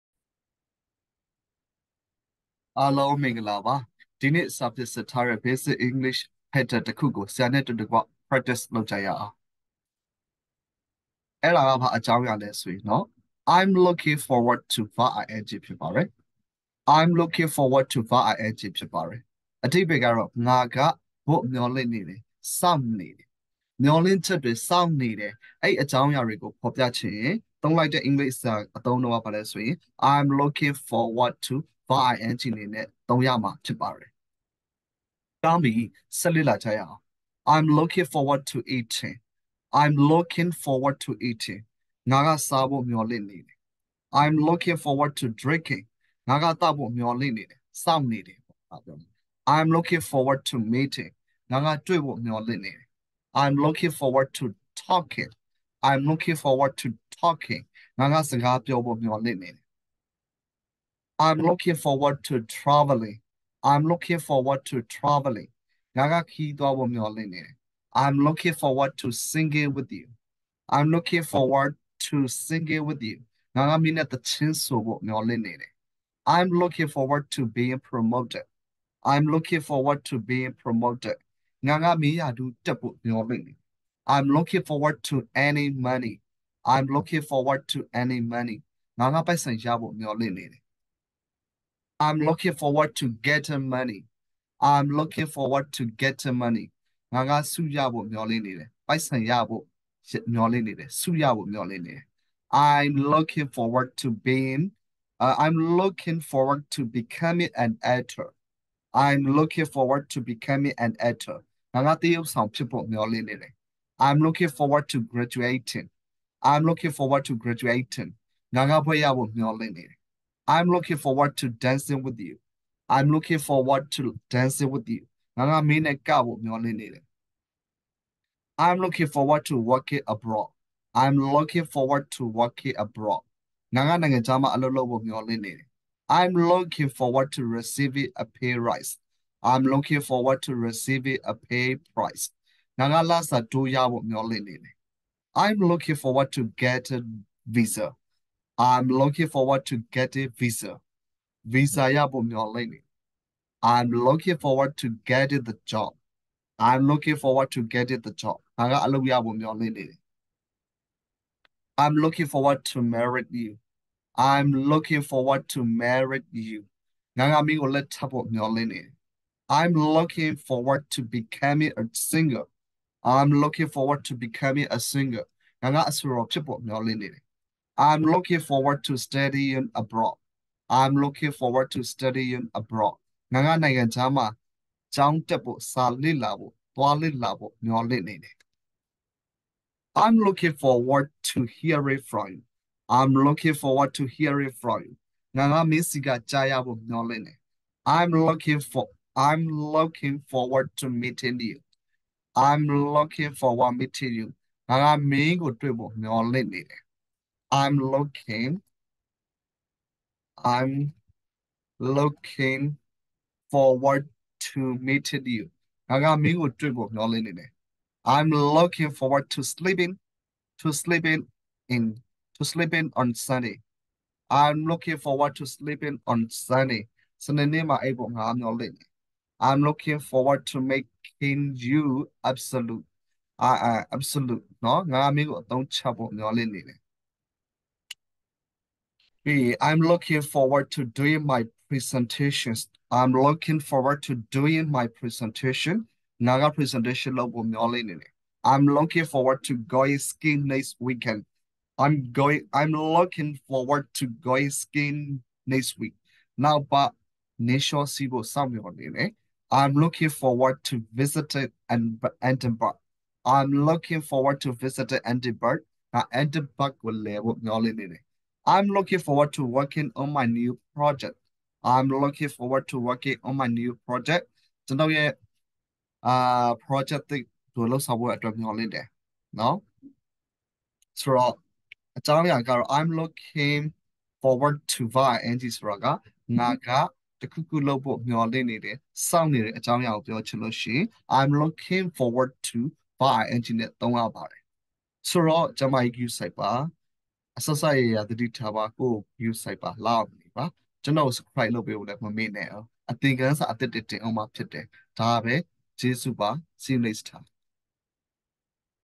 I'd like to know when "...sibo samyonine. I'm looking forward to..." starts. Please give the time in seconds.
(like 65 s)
257 s.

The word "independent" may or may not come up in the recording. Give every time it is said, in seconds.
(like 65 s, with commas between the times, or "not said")
not said.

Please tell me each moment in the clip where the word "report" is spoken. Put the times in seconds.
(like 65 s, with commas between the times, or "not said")
not said.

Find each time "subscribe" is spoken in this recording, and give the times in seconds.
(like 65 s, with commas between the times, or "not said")
301 s.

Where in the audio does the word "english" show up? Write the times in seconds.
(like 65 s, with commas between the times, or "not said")
5 s, 28 s.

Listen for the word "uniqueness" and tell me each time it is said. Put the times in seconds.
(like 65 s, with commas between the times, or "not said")
not said.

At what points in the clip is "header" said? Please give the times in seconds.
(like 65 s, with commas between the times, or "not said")
6 s.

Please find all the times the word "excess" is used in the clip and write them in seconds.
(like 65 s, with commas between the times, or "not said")
not said.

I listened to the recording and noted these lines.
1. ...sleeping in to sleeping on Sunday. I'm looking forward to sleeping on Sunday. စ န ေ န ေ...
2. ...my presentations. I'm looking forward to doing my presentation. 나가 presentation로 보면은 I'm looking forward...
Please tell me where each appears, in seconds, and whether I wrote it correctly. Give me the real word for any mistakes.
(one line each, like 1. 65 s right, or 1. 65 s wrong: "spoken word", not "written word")
1. 220 s right
2. 241 s right.